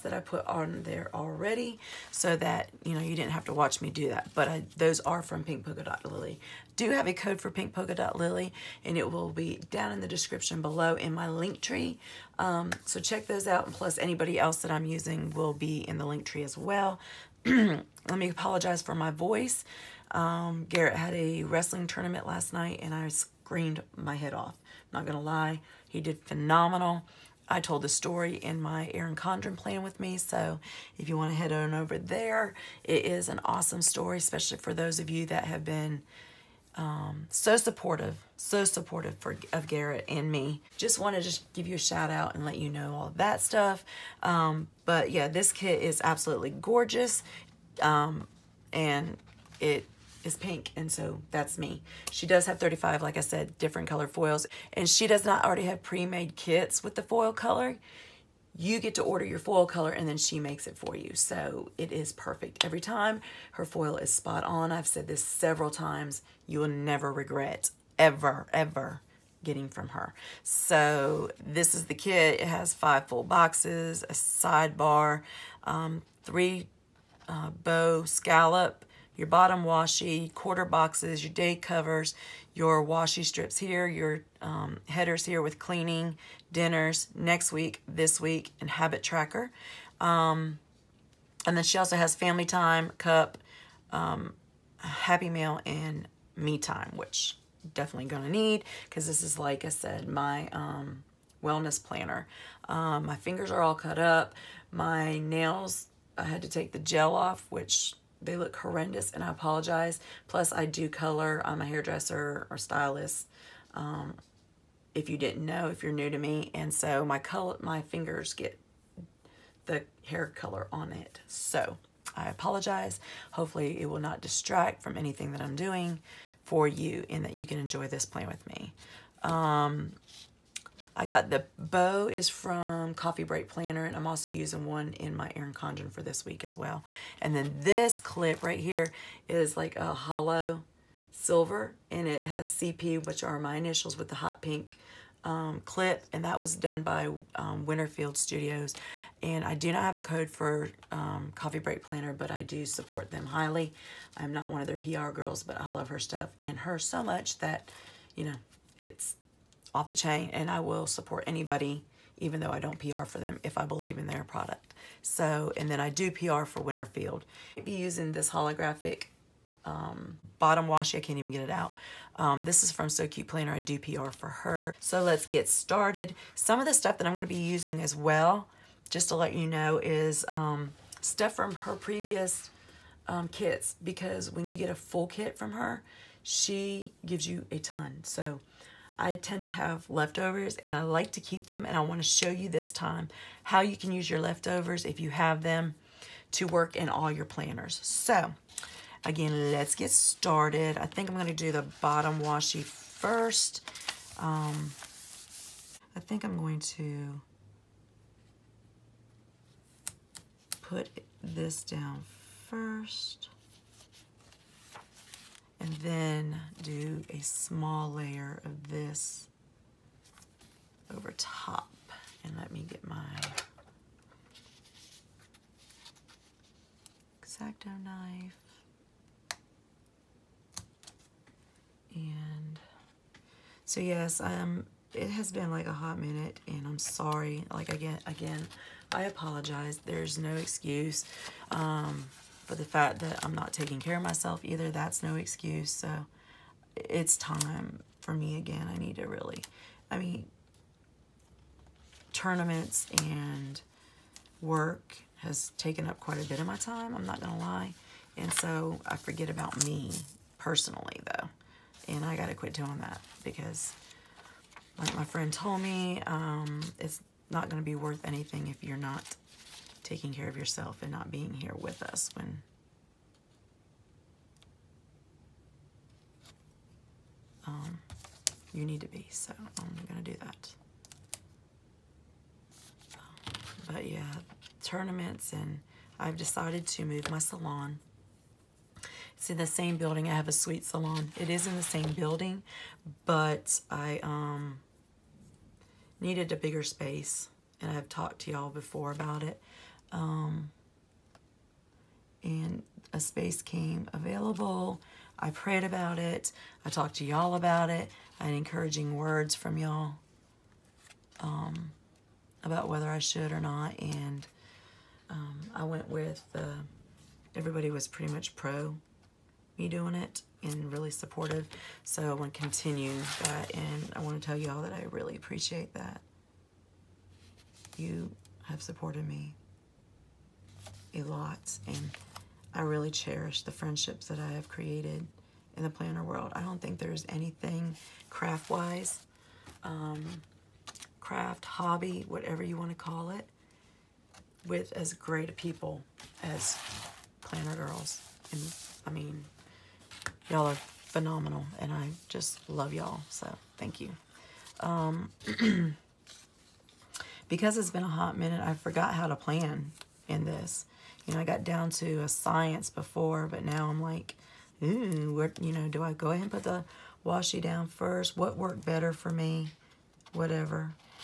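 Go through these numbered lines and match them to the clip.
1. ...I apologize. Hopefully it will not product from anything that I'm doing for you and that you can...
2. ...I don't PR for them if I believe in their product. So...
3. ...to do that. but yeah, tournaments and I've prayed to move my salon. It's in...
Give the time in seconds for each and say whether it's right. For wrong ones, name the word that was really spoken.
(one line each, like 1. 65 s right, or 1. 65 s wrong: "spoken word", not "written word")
1. 122 s wrong: "distract", not "product"
2. 162 s right
3. 280 s wrong: "decided", not "prayed".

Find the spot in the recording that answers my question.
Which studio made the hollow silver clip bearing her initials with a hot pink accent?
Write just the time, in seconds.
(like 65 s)
147 s.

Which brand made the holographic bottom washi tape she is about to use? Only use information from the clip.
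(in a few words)
So Cute Planner.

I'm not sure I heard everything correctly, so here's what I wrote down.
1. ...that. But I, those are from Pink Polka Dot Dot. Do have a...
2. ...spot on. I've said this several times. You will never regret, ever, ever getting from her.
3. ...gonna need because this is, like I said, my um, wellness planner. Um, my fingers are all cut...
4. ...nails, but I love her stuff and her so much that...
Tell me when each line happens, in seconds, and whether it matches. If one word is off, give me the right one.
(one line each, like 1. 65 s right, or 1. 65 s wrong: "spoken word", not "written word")
1. 4 s wrong: "Lily", not "Dot"
2. 64 s right
3. 98 s right
4. 155 s wrong: "girls", not "nails".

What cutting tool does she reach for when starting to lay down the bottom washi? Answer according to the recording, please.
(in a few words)
Exacto knife.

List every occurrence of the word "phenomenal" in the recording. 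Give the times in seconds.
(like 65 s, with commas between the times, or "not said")
26 s, 350 s.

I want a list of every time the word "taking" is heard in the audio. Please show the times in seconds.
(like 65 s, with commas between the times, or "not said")
243 s, 269 s.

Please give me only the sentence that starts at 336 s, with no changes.
I don't think there's anything craft-wise, um, craft, hobby, whatever you want to call it, with as great people as planner girls.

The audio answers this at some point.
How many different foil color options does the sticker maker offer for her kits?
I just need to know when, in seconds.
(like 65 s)
52 s.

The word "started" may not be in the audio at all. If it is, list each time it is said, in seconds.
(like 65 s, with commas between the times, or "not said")
175 s, 199 s.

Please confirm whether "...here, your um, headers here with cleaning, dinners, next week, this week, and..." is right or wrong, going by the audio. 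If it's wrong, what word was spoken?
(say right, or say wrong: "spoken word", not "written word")
right.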